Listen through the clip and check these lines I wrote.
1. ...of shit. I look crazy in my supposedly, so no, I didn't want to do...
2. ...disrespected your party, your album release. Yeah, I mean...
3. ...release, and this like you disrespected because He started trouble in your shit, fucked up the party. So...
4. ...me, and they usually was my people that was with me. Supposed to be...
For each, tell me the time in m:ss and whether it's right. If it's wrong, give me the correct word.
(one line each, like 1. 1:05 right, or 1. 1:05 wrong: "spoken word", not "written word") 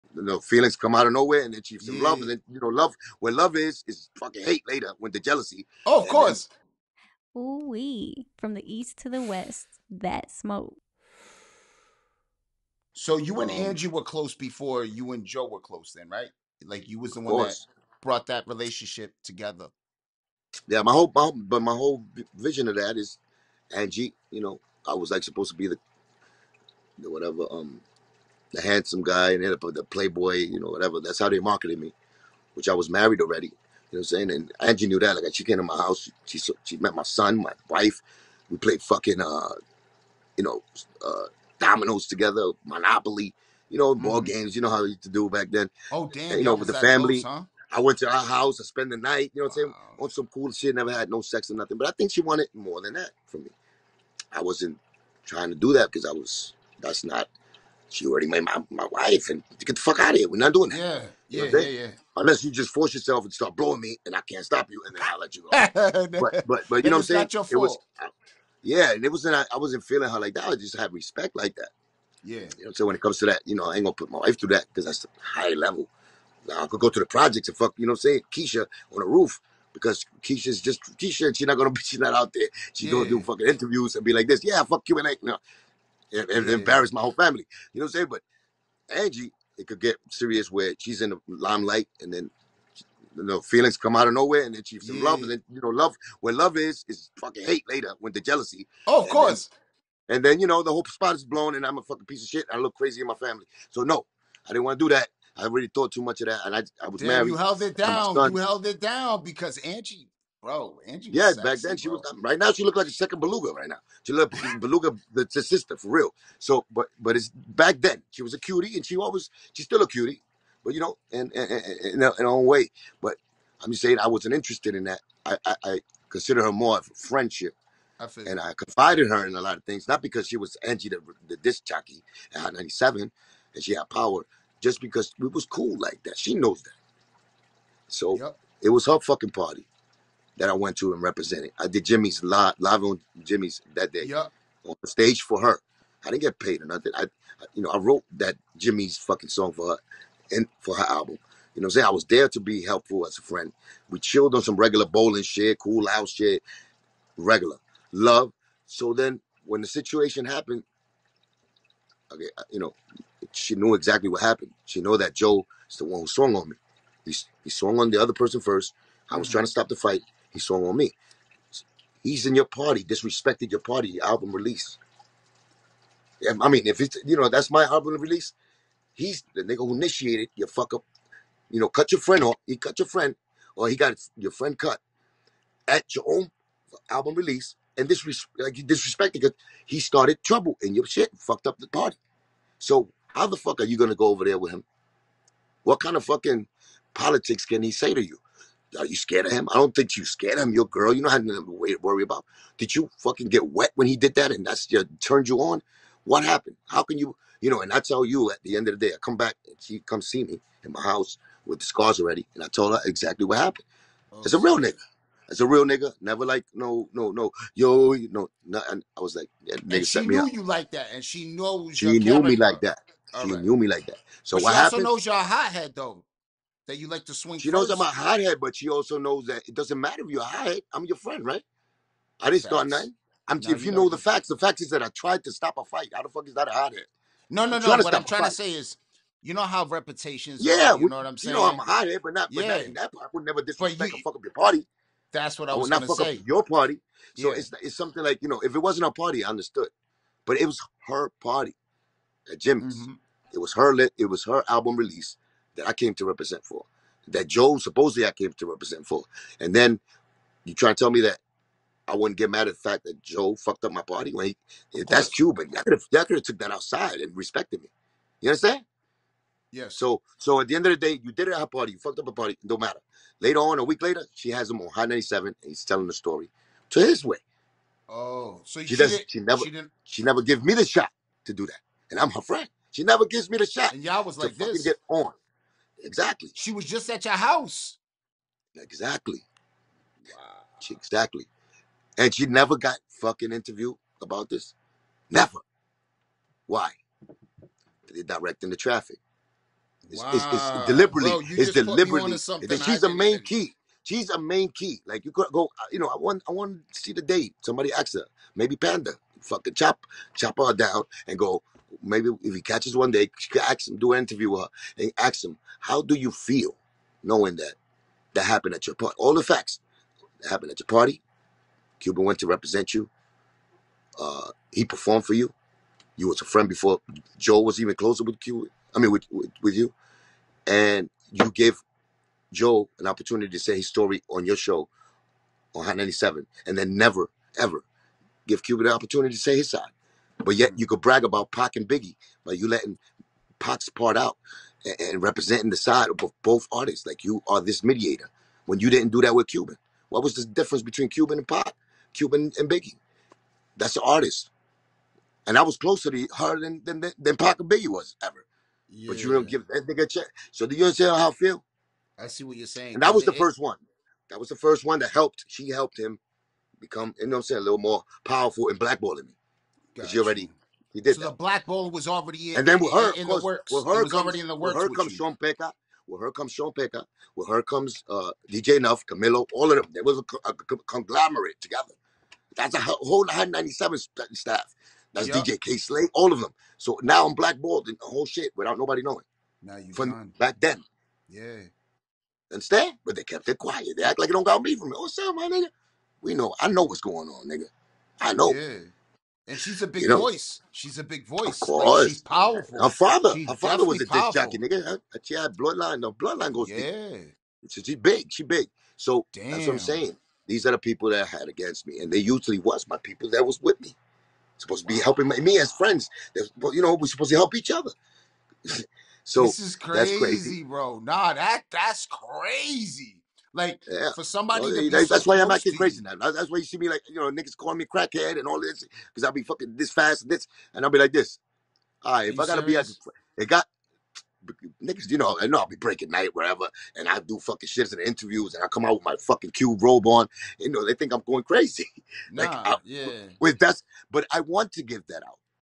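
1. 1:42 wrong: "family", not "supposedly"
2. 2:52 right
3. 3:07 right
4. 6:51 right.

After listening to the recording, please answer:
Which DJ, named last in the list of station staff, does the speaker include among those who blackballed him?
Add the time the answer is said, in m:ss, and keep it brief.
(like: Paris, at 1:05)
DJ Kay Slay, at 6:25.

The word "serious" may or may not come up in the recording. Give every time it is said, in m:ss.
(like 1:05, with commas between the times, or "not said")
1:30, 7:12.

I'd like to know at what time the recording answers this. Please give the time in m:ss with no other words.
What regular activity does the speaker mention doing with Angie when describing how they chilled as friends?
2:34.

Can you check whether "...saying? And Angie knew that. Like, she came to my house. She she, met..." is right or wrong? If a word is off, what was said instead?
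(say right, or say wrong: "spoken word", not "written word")
right.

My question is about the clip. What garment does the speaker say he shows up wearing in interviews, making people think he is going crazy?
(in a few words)
cube robe.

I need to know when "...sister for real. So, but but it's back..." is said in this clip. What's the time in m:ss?
1:55.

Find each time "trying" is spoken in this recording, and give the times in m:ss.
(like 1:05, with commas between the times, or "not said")
0:55, 2:49, 3:58.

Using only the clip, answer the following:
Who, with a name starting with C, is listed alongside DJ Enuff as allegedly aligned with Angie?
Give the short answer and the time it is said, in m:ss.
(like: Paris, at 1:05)
Camilo, at 6:18.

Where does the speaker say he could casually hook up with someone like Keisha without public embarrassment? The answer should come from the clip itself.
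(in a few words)
the projects.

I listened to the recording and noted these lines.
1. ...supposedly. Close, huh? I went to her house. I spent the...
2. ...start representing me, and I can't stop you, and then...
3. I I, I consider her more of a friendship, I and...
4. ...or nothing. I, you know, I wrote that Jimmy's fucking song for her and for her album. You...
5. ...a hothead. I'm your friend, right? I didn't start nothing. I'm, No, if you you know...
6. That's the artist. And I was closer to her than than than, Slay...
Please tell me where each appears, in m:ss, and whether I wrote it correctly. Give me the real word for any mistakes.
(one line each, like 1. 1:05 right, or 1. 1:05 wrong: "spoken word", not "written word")
1. 0:46 wrong: "family", not "supposedly"
2. 1:03 wrong: "blowing", not "representing"
3. 2:05 right
4. 2:26 right
5. 3:50 right
6. 5:53 wrong: "Pac", not "Slay".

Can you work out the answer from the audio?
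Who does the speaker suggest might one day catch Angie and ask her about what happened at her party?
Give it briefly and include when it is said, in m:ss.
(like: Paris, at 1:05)
Panda, at 5:08.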